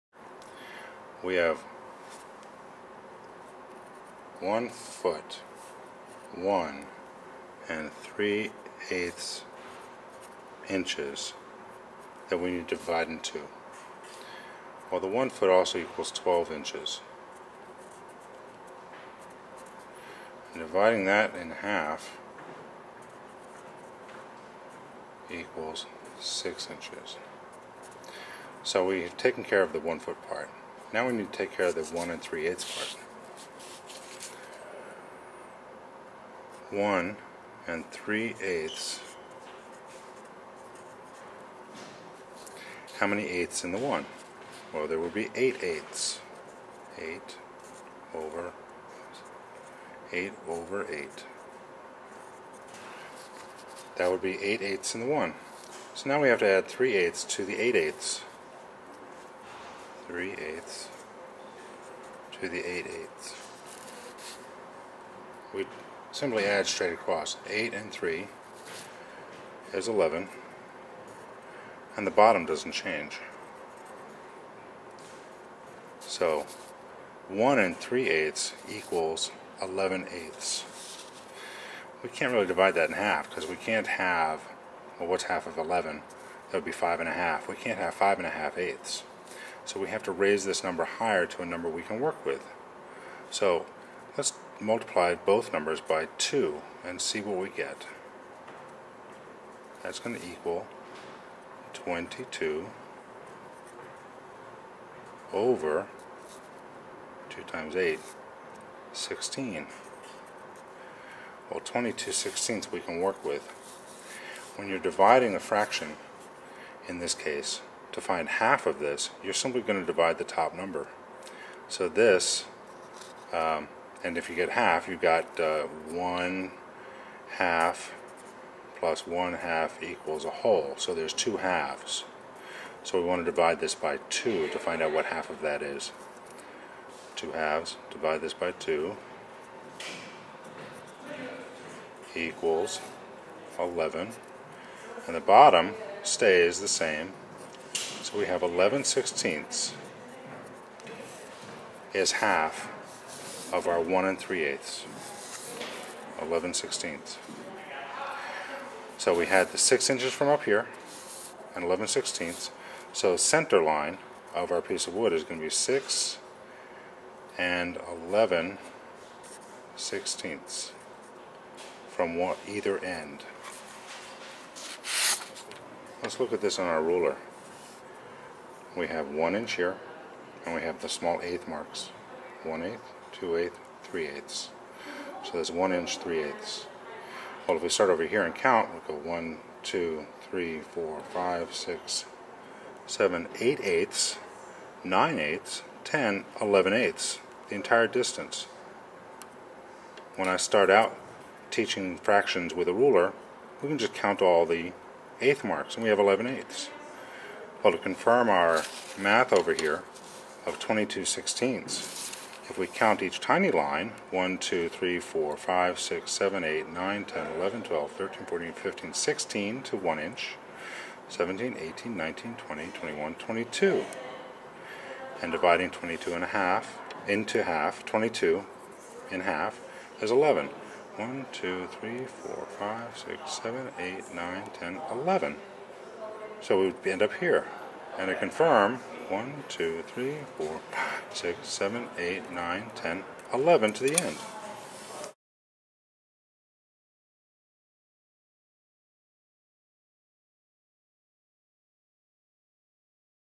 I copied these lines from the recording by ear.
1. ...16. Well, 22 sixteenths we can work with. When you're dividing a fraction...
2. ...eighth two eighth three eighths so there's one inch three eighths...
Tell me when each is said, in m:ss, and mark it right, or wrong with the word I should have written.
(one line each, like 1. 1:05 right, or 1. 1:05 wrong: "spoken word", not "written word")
1. 1:48 right
2. 3:02 right.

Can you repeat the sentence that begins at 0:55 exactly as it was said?
So now we have to add 3 eighths to the 8 eighths.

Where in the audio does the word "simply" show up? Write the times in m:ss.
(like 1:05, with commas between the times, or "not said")
1:06, 1:59.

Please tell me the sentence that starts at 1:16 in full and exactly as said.
So 1 and 3 eighths equals 11 eighths.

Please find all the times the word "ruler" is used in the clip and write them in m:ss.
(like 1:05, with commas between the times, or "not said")
2:56, 3:22.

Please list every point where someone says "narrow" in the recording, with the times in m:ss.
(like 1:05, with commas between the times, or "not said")
not said.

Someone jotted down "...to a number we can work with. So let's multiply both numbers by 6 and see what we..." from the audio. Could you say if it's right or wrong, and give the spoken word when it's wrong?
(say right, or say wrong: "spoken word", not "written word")
wrong: "2", not "6".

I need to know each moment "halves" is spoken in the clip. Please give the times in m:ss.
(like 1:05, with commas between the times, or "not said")
2:11, 2:17.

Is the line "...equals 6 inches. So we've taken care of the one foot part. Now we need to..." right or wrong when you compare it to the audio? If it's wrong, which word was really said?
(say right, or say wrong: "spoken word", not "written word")
right.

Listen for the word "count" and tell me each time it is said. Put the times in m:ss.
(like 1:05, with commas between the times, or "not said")
3:08, 3:23.